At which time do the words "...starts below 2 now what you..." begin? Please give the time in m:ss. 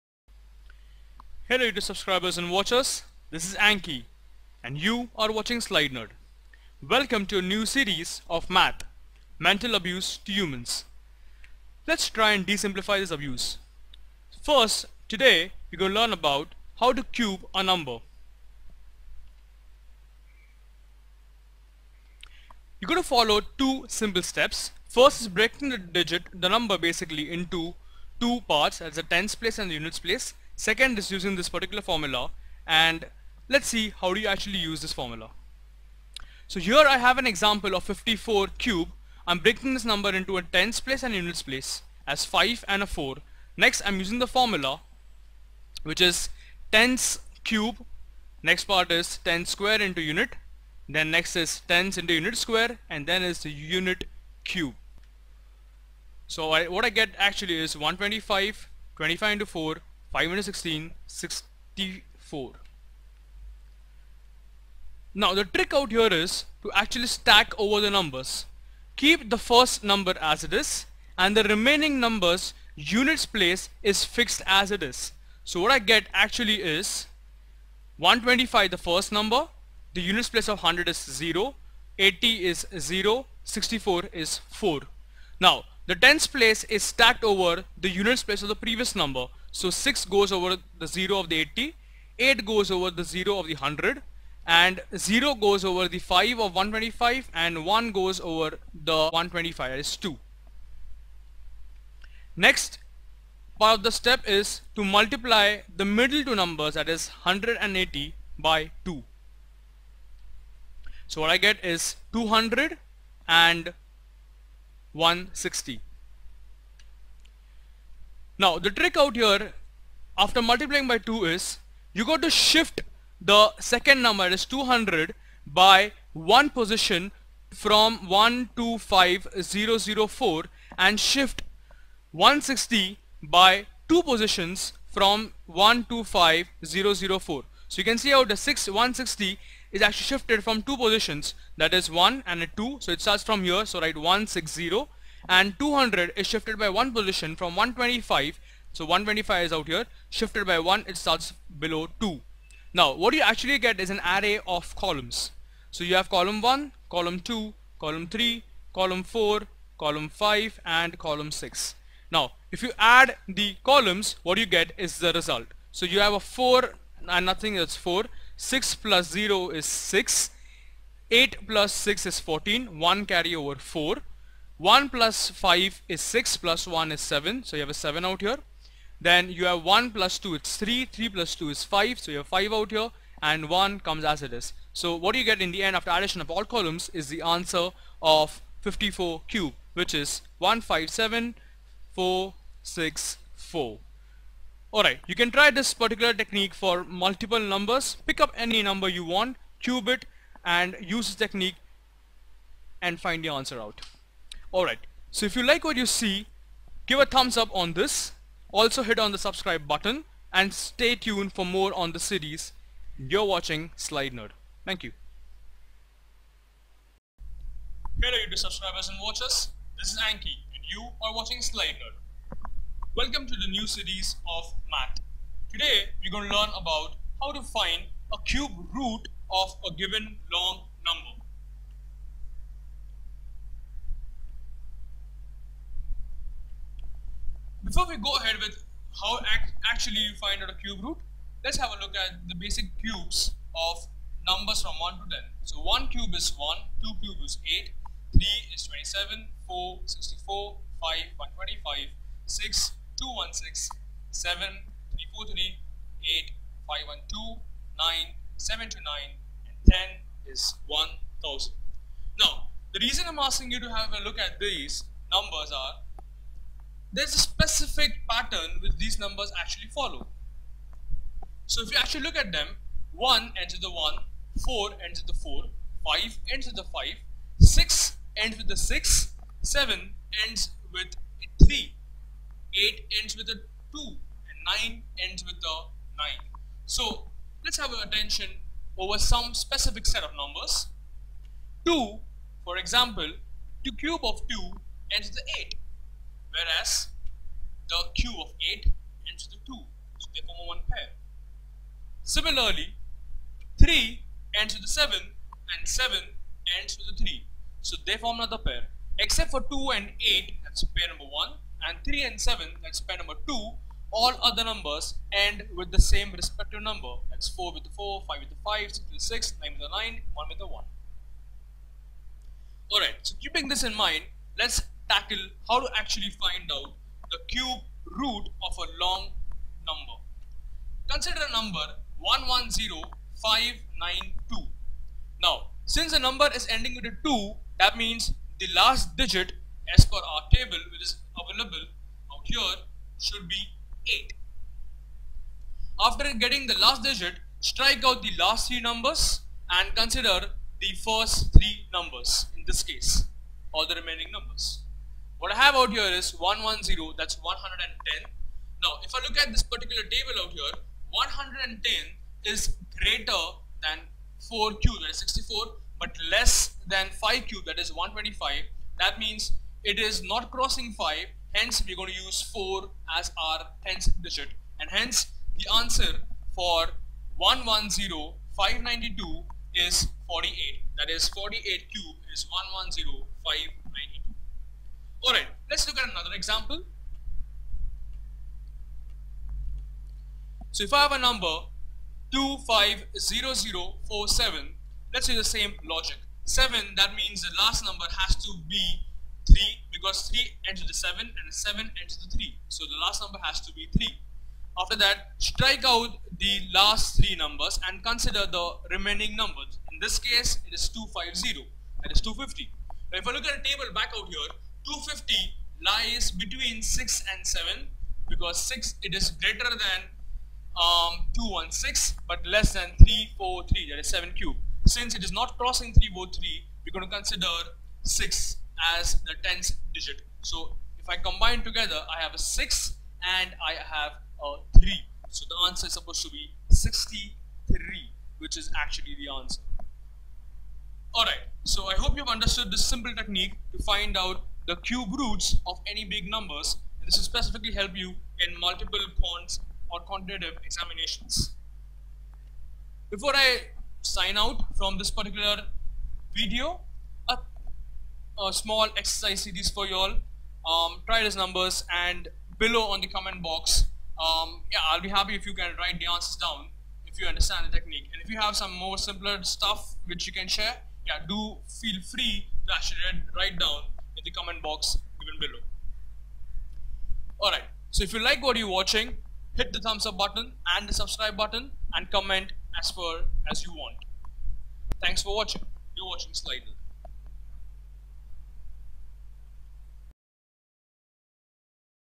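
2:30.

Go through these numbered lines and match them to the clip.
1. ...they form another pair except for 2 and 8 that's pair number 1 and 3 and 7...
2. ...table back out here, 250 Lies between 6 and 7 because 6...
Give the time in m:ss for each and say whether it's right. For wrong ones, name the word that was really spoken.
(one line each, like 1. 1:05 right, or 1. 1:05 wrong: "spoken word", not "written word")
1. 5:07 right
2. 6:53 right.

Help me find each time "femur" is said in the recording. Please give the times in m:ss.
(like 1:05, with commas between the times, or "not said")
not said.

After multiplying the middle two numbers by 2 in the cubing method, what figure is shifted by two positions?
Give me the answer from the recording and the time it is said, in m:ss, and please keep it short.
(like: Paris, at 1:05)
160, at 2:10.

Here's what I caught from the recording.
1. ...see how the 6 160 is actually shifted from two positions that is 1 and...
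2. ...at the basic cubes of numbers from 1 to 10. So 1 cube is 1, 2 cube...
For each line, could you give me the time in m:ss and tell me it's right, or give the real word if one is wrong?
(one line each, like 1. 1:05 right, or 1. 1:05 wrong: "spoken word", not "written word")
1. 2:18 right
2. 4:01 right.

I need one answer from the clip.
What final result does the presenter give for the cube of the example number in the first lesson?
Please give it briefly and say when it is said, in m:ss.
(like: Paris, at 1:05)
157464, at 3:10.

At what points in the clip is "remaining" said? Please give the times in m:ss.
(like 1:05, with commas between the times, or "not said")
1:11, 5:53, 6:48.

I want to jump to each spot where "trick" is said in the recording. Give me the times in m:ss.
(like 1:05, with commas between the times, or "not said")
1:05, 1:58.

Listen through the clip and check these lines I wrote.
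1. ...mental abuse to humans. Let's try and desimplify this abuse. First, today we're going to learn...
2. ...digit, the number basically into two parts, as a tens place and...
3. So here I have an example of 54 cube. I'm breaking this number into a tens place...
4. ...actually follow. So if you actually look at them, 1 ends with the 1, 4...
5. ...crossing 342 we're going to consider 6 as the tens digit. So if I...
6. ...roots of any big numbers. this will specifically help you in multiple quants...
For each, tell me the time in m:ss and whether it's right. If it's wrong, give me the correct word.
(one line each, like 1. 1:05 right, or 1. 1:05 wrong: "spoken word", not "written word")
1. 0:09 right
2. 0:25 right
3. 0:36 right
4. 4:29 right
5. 7:05 wrong: "343", not "342"
6. 7:24 right.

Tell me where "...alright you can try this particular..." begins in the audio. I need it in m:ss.
3:14.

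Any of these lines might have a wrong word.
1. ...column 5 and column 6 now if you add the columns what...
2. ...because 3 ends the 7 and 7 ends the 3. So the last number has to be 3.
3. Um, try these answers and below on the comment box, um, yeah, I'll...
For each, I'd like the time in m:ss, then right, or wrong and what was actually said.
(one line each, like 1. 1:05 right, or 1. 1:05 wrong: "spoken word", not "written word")
1. 2:39 right
2. 6:39 right
3. 7:40 wrong: "numbers", not "answers".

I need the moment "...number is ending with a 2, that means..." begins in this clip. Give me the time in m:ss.
5:36.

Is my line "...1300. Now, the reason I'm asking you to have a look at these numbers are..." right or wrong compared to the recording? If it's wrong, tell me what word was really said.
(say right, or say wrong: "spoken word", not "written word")
wrong: "1000", not "1300".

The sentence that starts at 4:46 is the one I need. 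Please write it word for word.
So let's have our attention over some specific set of numbers.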